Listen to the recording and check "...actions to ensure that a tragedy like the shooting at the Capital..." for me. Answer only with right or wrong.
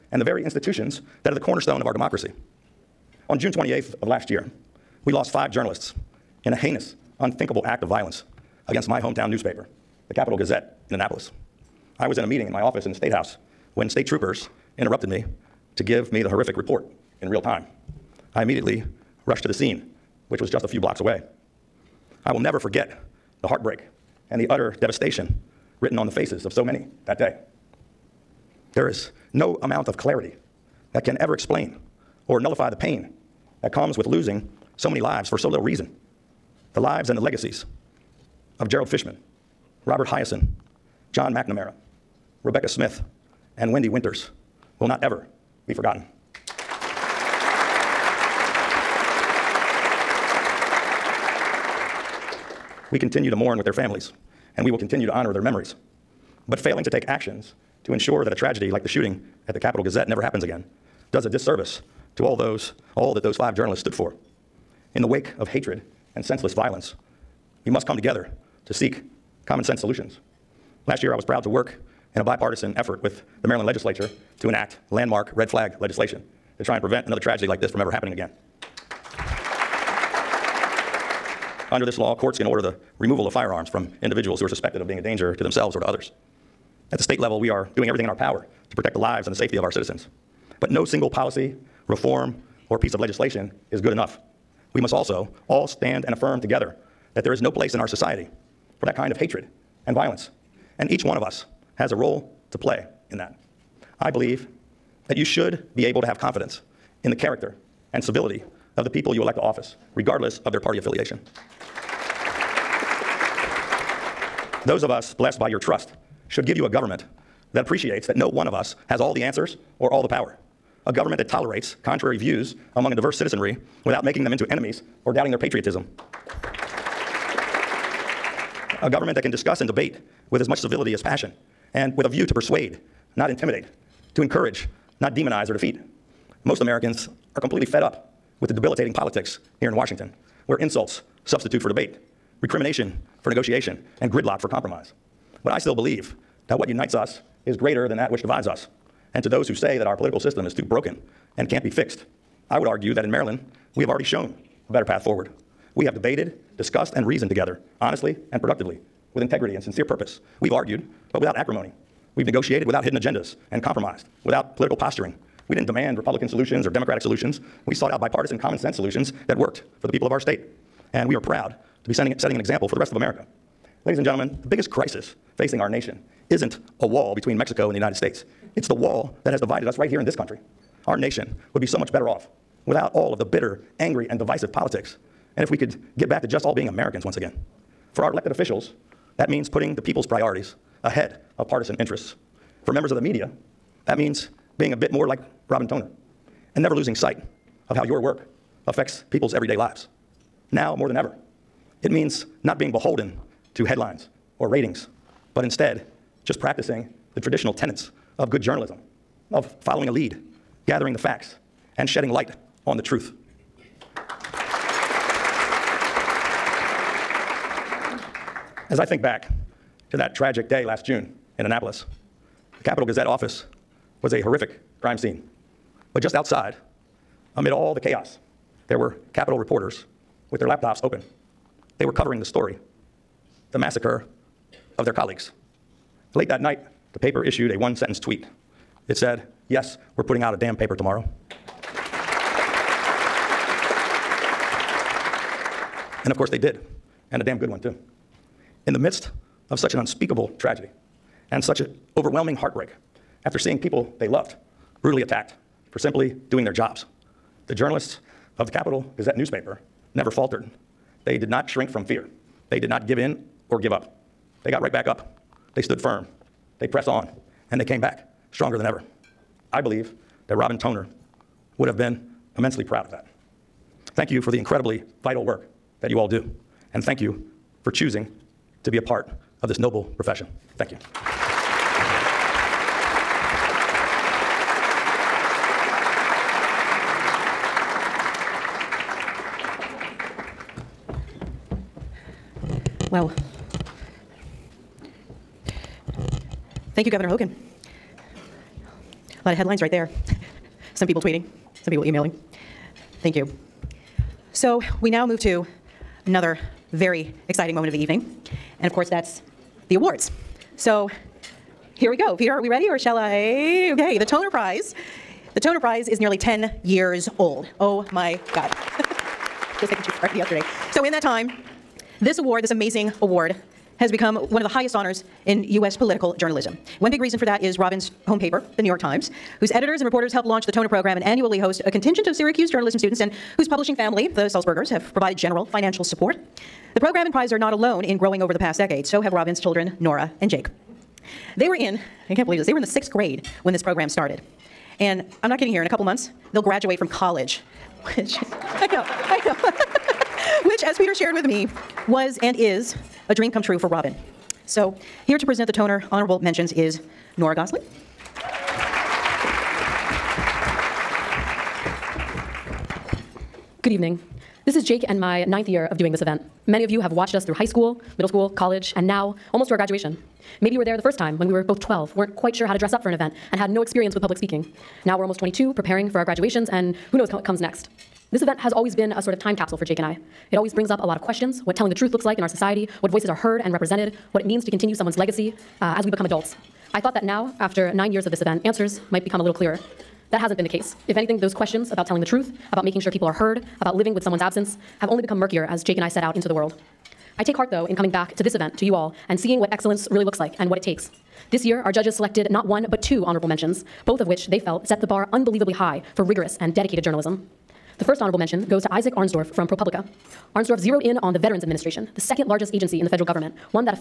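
right.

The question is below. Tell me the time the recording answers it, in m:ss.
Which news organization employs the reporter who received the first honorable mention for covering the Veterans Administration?
6:49.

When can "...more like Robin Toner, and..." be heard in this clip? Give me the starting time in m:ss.
3:14.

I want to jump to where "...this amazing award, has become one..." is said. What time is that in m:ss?
5:22.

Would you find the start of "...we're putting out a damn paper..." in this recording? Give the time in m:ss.
3:59.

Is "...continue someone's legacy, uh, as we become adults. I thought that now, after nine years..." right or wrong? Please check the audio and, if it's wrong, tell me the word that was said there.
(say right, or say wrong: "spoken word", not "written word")
right.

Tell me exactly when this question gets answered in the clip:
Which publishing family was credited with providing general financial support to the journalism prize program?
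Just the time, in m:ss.
5:34.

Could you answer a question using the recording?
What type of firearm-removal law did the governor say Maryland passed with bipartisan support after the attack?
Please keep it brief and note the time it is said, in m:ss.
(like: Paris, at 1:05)
red flag legislation, at 1:15.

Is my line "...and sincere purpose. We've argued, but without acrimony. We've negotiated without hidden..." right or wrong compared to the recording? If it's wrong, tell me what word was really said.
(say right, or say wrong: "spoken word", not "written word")
right.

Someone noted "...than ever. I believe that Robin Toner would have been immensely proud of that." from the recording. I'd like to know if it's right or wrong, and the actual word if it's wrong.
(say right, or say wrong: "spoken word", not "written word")
right.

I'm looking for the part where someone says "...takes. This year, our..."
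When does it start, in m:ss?
6:40.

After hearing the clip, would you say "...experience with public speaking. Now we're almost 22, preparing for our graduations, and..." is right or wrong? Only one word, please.
right.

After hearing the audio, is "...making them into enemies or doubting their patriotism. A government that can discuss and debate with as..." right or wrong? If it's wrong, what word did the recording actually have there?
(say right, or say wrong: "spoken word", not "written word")
right.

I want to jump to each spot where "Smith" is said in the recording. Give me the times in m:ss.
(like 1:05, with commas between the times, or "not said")
0:42.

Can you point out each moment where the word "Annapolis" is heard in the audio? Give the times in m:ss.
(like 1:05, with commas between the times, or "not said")
0:10, 3:41.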